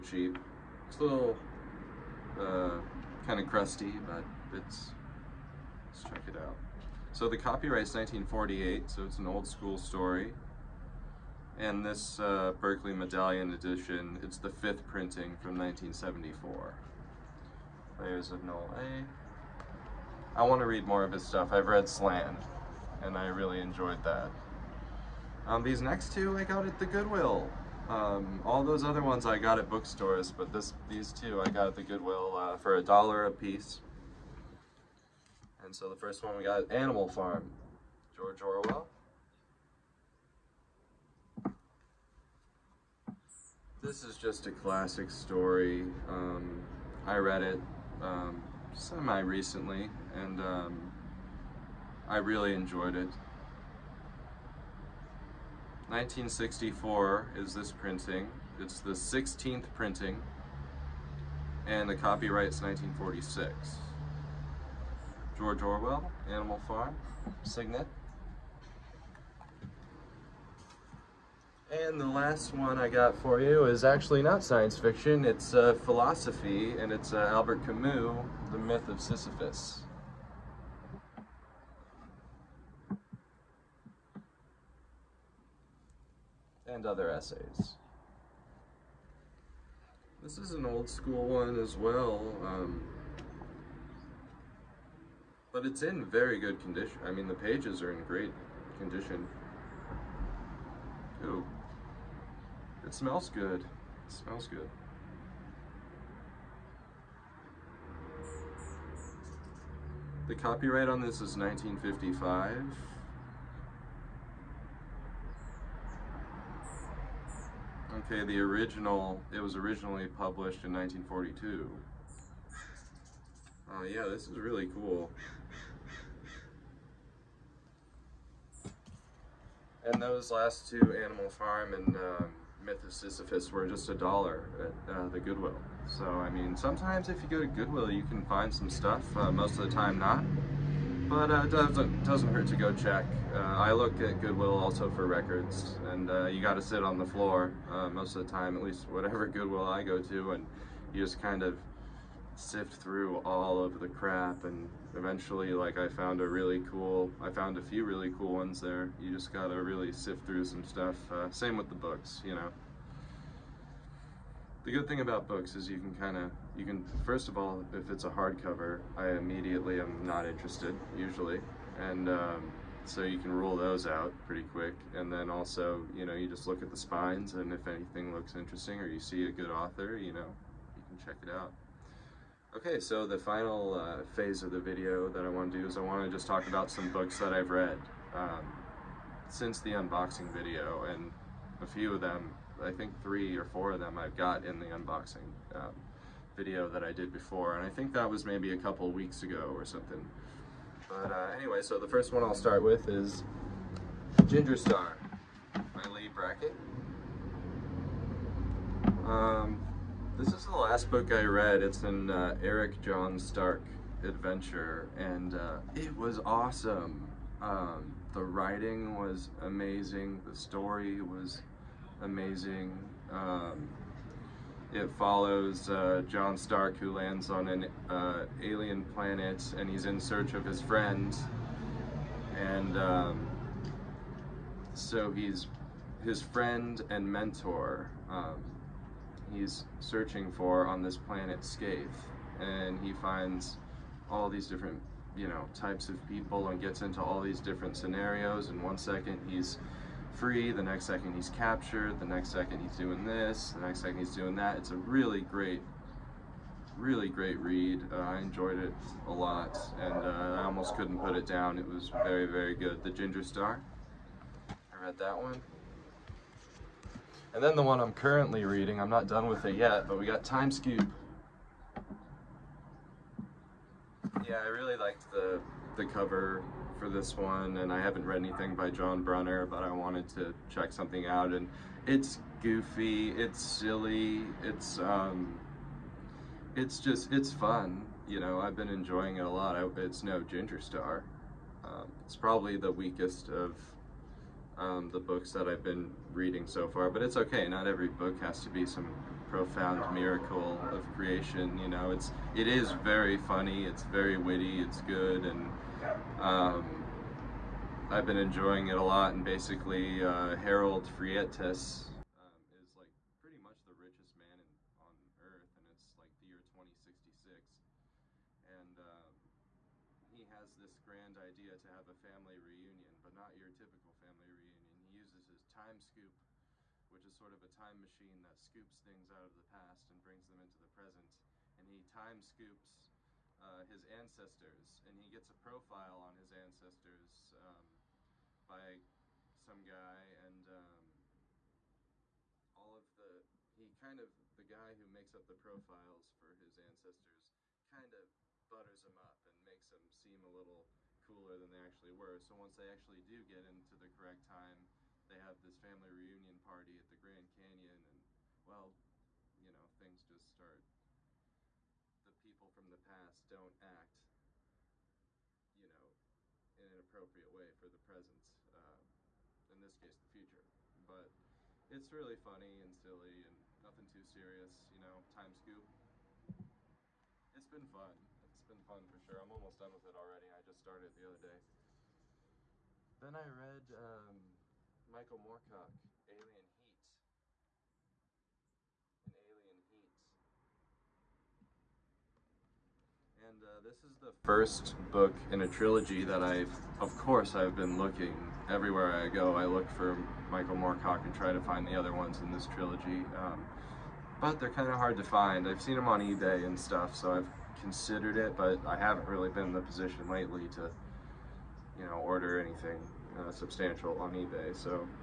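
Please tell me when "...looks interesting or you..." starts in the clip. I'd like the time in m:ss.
2:58.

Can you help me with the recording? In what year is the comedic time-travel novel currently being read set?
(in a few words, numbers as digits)
2066.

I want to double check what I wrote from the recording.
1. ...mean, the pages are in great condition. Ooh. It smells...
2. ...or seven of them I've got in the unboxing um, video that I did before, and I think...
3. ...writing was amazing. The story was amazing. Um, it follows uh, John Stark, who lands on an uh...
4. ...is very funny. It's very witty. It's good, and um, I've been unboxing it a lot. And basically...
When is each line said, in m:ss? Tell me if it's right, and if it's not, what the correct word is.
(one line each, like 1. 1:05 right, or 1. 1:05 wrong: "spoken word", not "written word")
1. 1:37 right
2. 3:13 wrong: "four", not "seven"
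3. 3:38 right
4. 5:02 wrong: "enjoying", not "unboxing".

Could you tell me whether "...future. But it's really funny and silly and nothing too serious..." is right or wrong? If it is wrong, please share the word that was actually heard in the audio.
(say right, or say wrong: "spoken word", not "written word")
right.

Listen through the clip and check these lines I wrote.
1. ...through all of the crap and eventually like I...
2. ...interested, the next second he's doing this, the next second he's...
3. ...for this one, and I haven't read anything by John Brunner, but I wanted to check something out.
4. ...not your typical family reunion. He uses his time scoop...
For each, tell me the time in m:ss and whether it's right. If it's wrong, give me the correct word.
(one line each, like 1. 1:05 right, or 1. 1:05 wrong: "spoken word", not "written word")
1. 2:32 right
2. 4:11 wrong: "captured", not "interested"
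3. 4:36 right
4. 5:23 right.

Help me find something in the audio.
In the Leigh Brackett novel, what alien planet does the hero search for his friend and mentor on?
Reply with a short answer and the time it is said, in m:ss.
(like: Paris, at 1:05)
Scathe, at 4:01.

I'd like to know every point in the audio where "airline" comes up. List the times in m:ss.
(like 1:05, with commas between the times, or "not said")
not said.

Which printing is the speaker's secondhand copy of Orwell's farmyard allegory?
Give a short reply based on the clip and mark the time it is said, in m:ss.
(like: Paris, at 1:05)
16th, at 0:58.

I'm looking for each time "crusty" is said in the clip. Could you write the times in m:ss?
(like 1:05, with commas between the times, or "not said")
0:03.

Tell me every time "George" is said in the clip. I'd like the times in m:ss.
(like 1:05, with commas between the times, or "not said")
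0:38, 1:05.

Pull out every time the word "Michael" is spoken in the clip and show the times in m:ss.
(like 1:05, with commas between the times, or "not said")
6:24, 6:40.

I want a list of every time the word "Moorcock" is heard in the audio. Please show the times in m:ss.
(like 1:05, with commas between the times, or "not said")
6:25, 6:40.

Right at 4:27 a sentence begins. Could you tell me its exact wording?
And then the one I'm currently reading, I'm not done with it yet, but we got Time Scoop.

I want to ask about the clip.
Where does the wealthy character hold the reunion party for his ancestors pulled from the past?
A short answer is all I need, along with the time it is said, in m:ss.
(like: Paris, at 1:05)
Grand Canyon, at 5:56.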